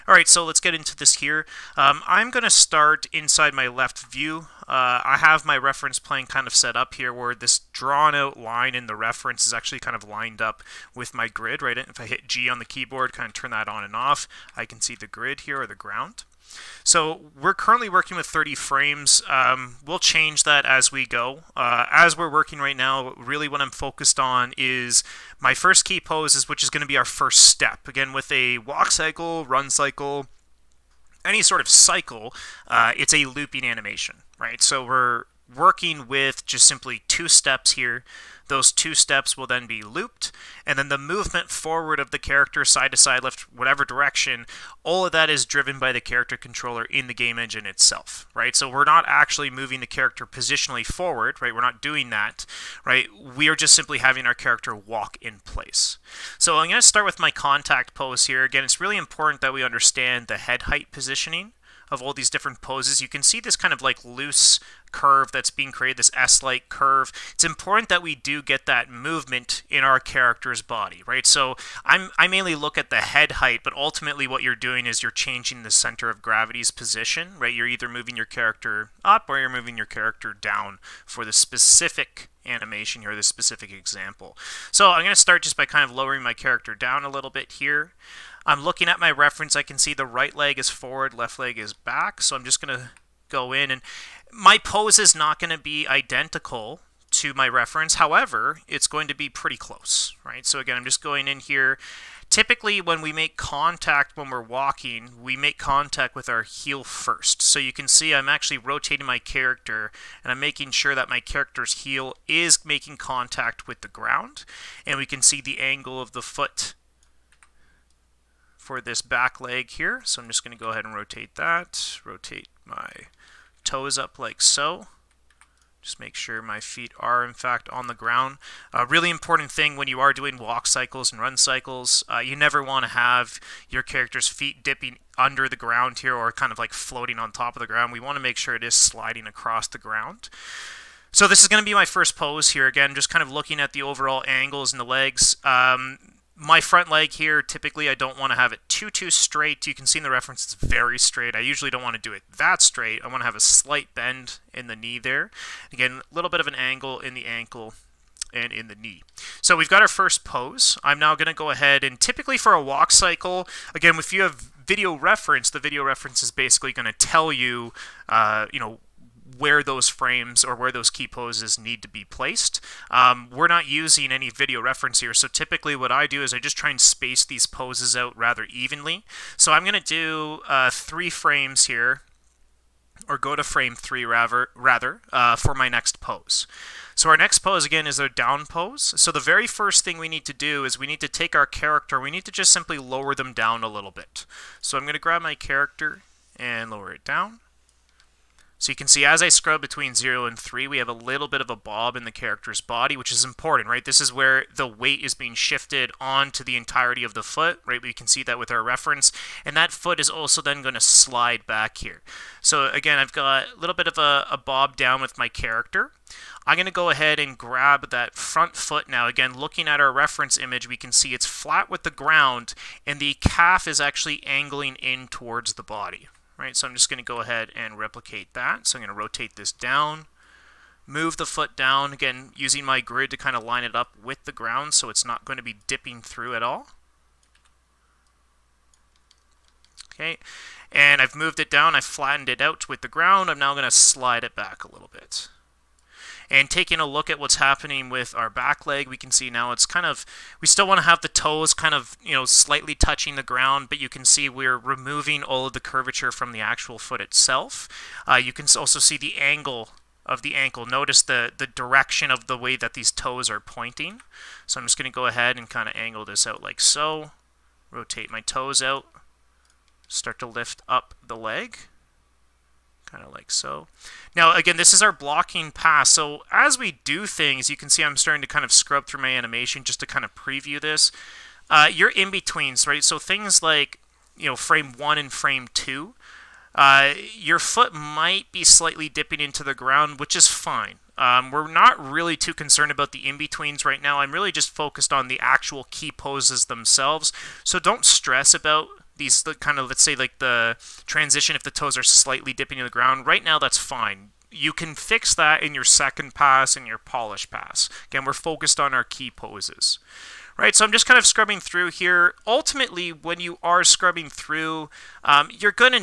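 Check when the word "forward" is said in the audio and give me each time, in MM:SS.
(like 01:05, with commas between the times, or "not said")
00:41, 00:50, 01:30.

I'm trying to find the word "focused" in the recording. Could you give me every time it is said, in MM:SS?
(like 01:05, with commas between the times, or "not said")
00:23, 04:54, 05:08.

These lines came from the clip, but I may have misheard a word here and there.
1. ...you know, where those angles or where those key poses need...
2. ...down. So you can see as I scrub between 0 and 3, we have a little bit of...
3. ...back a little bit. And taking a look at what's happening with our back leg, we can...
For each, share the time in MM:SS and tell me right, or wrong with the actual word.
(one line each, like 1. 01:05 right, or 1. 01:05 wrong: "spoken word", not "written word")
1. 02:48 wrong: "frames", not "angles"
2. 03:17 right
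3. 04:04 right.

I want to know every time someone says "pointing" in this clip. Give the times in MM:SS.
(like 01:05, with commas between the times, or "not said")
04:23.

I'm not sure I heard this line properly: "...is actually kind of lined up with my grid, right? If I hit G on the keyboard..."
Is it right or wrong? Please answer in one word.
right.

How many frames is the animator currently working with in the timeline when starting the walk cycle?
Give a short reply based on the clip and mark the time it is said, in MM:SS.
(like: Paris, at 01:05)
30, at 00:18.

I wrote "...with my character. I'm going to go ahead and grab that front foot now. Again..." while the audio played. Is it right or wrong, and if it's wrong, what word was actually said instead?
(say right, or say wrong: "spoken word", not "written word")
right.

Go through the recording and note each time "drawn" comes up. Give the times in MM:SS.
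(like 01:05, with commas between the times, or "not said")
00:07.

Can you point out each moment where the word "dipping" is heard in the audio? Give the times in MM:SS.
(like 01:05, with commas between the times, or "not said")
02:14, 03:55, 04:48, 05:02.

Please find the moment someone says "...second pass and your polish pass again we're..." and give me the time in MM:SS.
05:05.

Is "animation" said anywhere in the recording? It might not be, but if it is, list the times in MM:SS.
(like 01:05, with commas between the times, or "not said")
00:33, 01:22, 04:39.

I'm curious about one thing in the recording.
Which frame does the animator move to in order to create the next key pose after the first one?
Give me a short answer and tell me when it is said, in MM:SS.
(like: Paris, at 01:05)
3, at 03:03.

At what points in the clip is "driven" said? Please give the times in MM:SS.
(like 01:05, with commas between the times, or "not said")
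00:45.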